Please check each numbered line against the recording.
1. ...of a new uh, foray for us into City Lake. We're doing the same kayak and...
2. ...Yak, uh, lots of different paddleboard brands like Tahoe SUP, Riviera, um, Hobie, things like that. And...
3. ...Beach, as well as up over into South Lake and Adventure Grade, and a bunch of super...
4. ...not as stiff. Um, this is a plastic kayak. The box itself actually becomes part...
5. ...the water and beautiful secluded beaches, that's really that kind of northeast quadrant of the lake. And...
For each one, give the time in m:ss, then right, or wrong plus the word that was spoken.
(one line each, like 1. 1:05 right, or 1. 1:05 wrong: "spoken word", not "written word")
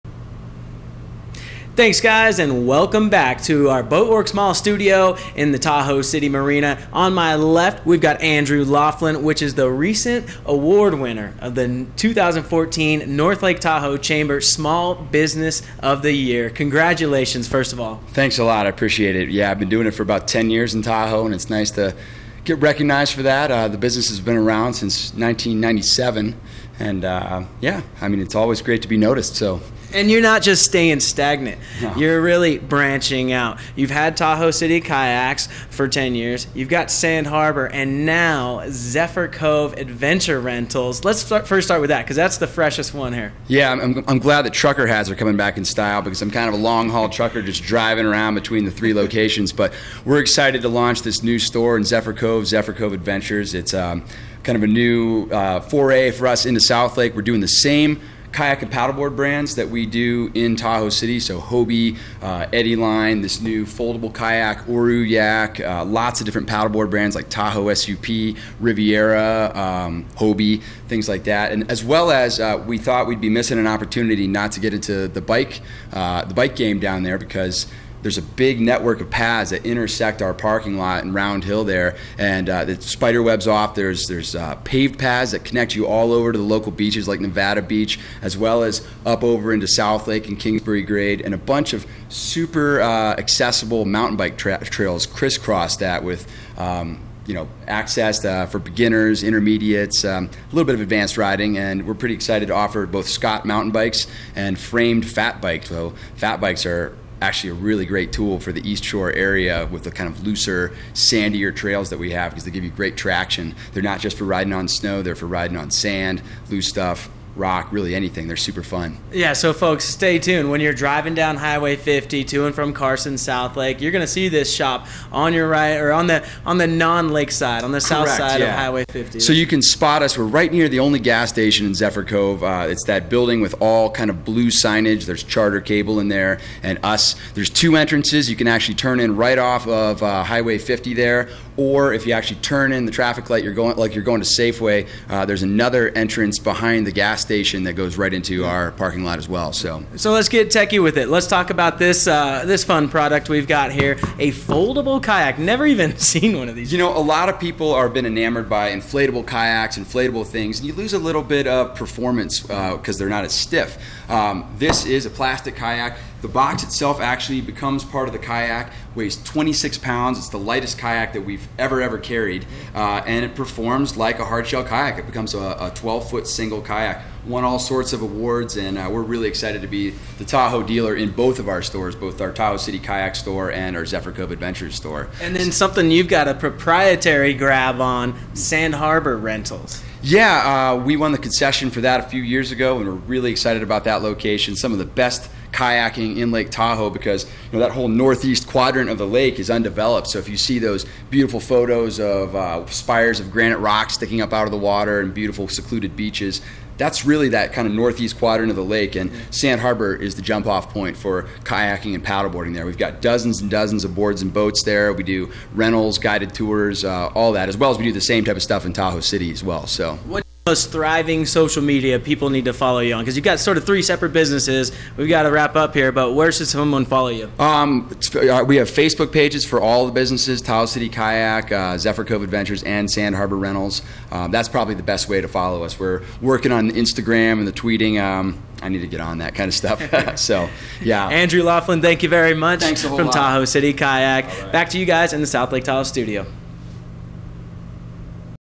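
1. 0:54 wrong: "South", not "City"
2. 1:05 right
3. 1:27 wrong: "Kingsbury", not "Adventure"
4. 2:43 right
5. 3:24 right.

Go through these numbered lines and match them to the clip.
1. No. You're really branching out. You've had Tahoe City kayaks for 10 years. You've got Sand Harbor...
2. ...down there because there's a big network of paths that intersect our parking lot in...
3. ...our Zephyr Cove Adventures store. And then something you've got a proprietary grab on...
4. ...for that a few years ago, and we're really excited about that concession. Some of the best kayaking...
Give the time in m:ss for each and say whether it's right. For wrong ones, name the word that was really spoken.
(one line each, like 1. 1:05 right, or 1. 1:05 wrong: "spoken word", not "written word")
1. 0:31 right
2. 1:16 right
3. 3:03 right
4. 3:11 wrong: "location", not "concession".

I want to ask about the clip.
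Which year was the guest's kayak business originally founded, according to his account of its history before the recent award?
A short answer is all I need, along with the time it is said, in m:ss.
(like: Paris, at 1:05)
1997, at 0:25.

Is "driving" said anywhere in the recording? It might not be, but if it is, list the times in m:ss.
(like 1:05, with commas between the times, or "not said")
0:47, 2:00.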